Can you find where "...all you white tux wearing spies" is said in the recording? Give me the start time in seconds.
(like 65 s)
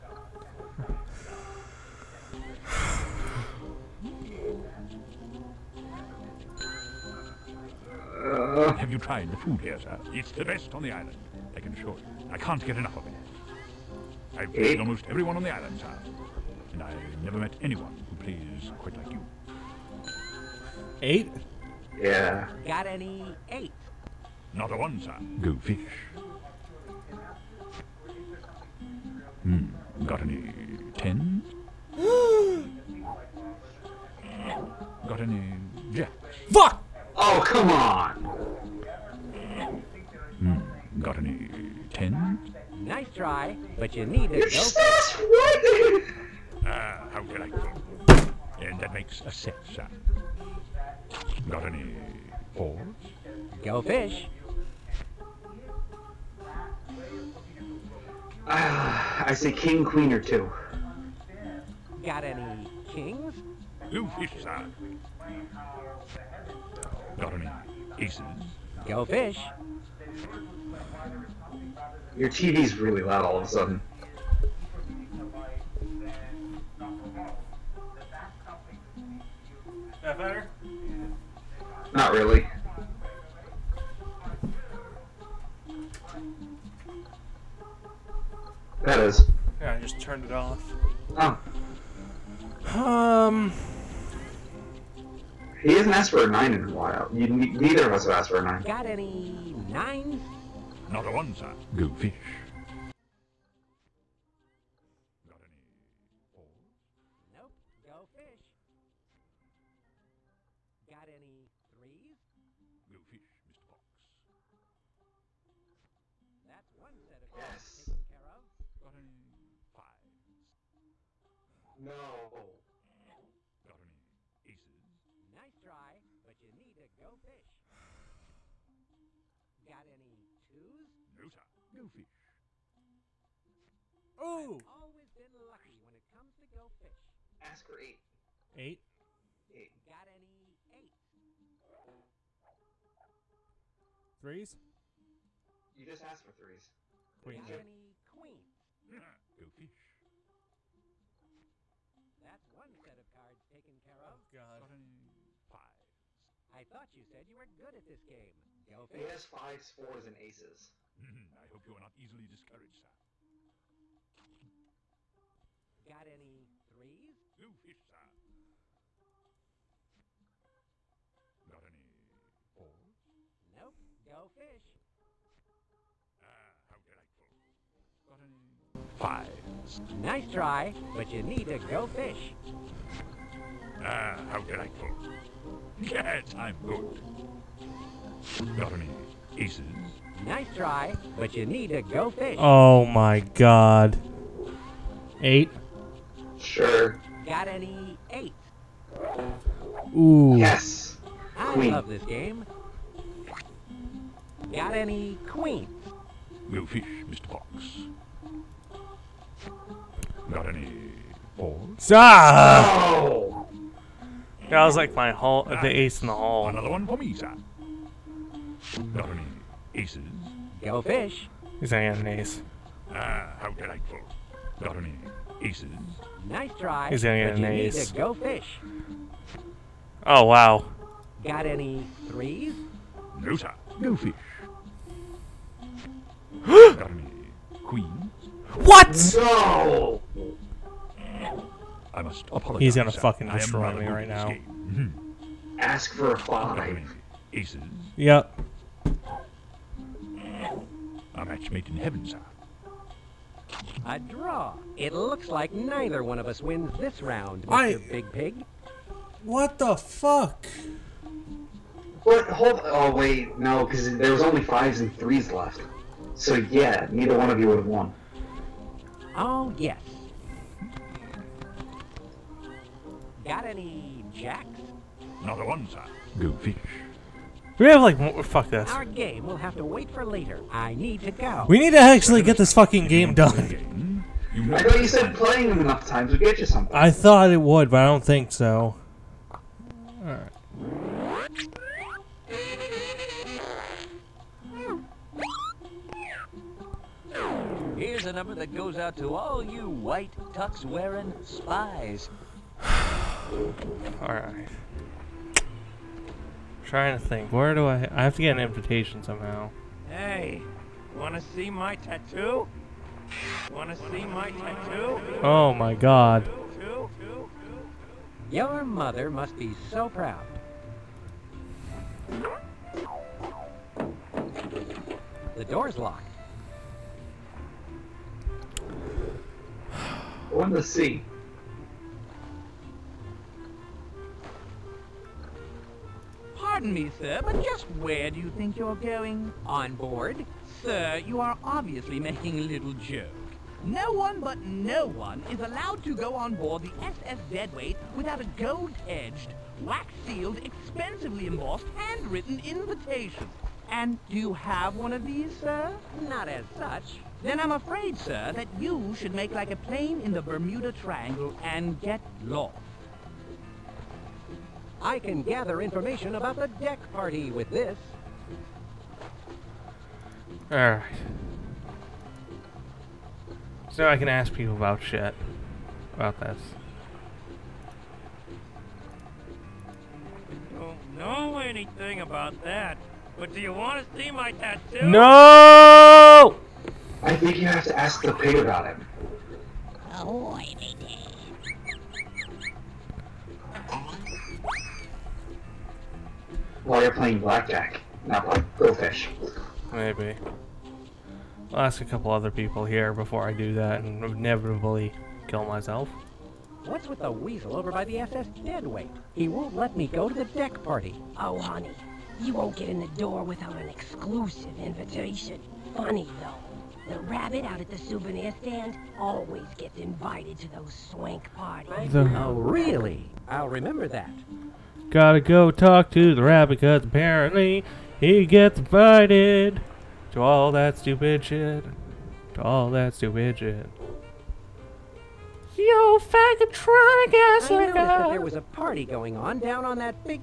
299 s.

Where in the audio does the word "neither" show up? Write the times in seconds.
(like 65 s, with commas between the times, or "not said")
97 s, 255 s, 266 s.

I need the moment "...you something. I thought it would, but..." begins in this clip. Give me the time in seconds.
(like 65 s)
286 s.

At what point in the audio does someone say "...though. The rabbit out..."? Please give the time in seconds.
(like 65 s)
416 s.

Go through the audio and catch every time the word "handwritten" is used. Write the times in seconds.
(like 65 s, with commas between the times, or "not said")
351 s.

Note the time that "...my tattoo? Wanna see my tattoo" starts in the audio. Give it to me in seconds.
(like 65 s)
311 s.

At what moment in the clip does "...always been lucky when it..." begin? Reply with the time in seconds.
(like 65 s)
134 s.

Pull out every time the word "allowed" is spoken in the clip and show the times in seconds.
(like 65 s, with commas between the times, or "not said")
345 s.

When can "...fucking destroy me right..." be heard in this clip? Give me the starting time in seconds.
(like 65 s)
242 s.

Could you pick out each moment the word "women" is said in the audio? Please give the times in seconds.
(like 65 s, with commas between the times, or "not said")
not said.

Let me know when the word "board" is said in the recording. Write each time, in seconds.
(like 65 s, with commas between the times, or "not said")
339 s, 346 s.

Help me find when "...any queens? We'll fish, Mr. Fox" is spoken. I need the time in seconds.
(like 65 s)
204 s.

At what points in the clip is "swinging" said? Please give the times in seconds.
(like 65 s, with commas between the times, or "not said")
not said.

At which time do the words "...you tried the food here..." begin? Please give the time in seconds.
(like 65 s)
8 s.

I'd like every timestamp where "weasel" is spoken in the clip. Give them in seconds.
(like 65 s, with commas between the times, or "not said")
407 s.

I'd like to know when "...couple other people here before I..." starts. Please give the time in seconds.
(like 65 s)
401 s.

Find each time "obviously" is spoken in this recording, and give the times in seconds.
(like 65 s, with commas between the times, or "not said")
341 s.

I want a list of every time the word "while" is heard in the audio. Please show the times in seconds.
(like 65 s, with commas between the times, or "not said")
96 s, 396 s.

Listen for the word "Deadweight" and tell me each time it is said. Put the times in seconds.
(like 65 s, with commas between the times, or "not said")
347 s, 408 s.